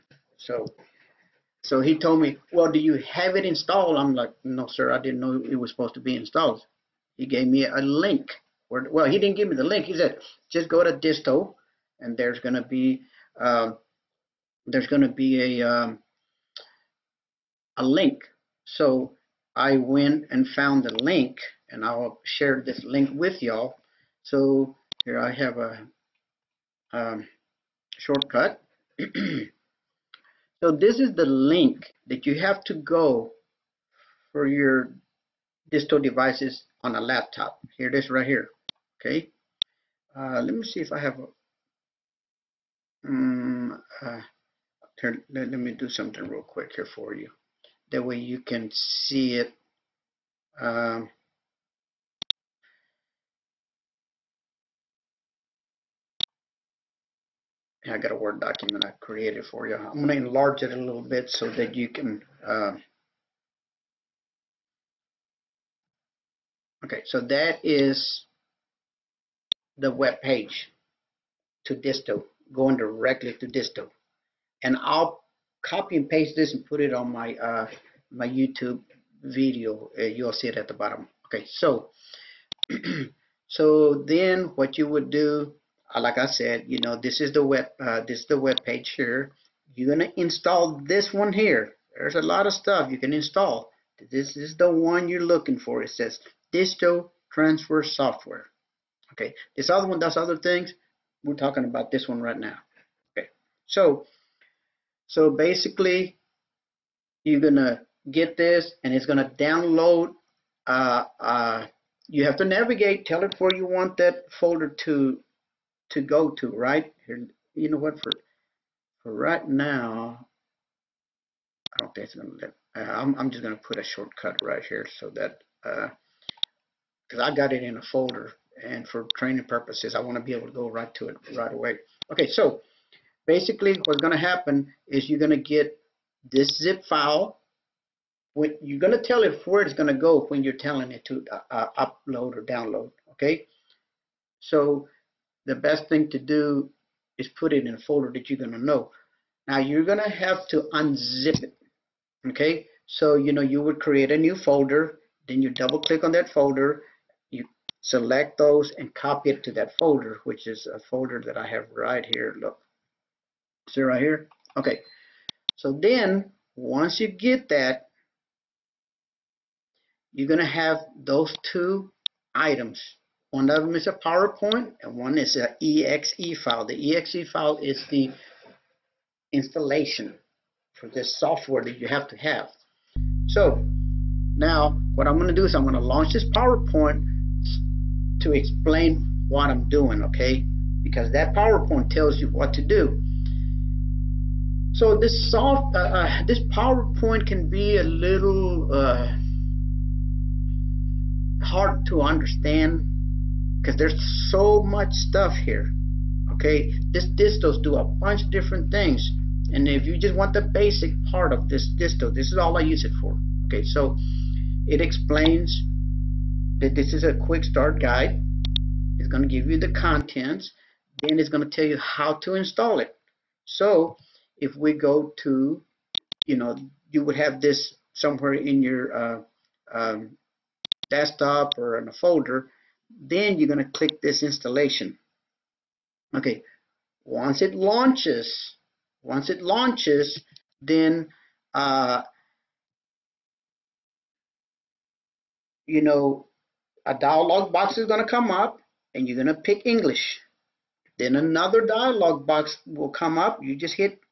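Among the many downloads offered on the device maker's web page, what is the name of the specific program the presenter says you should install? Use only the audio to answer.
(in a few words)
Disto Transfer Software.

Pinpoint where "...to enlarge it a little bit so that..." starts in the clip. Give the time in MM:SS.
01:00.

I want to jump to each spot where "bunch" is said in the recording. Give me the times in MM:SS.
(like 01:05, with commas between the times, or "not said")
03:28.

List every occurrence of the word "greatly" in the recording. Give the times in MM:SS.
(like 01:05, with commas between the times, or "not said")
not said.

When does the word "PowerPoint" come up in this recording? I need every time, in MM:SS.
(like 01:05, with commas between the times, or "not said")
02:53, 03:06, 03:11, 03:16.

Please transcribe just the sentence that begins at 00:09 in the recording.
He said, just go to Disto, and there's going to be um, there's going to be a um, a link.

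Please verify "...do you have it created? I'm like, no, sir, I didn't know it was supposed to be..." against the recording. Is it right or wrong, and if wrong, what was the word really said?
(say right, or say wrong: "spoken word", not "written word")
wrong: "installed", not "created".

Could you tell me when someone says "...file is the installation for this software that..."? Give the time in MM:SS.
02:57.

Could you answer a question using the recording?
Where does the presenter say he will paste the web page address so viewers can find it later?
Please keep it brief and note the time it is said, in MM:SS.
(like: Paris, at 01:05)
YouTube video, at 01:18.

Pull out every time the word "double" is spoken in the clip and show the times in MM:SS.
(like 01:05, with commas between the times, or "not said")
02:35.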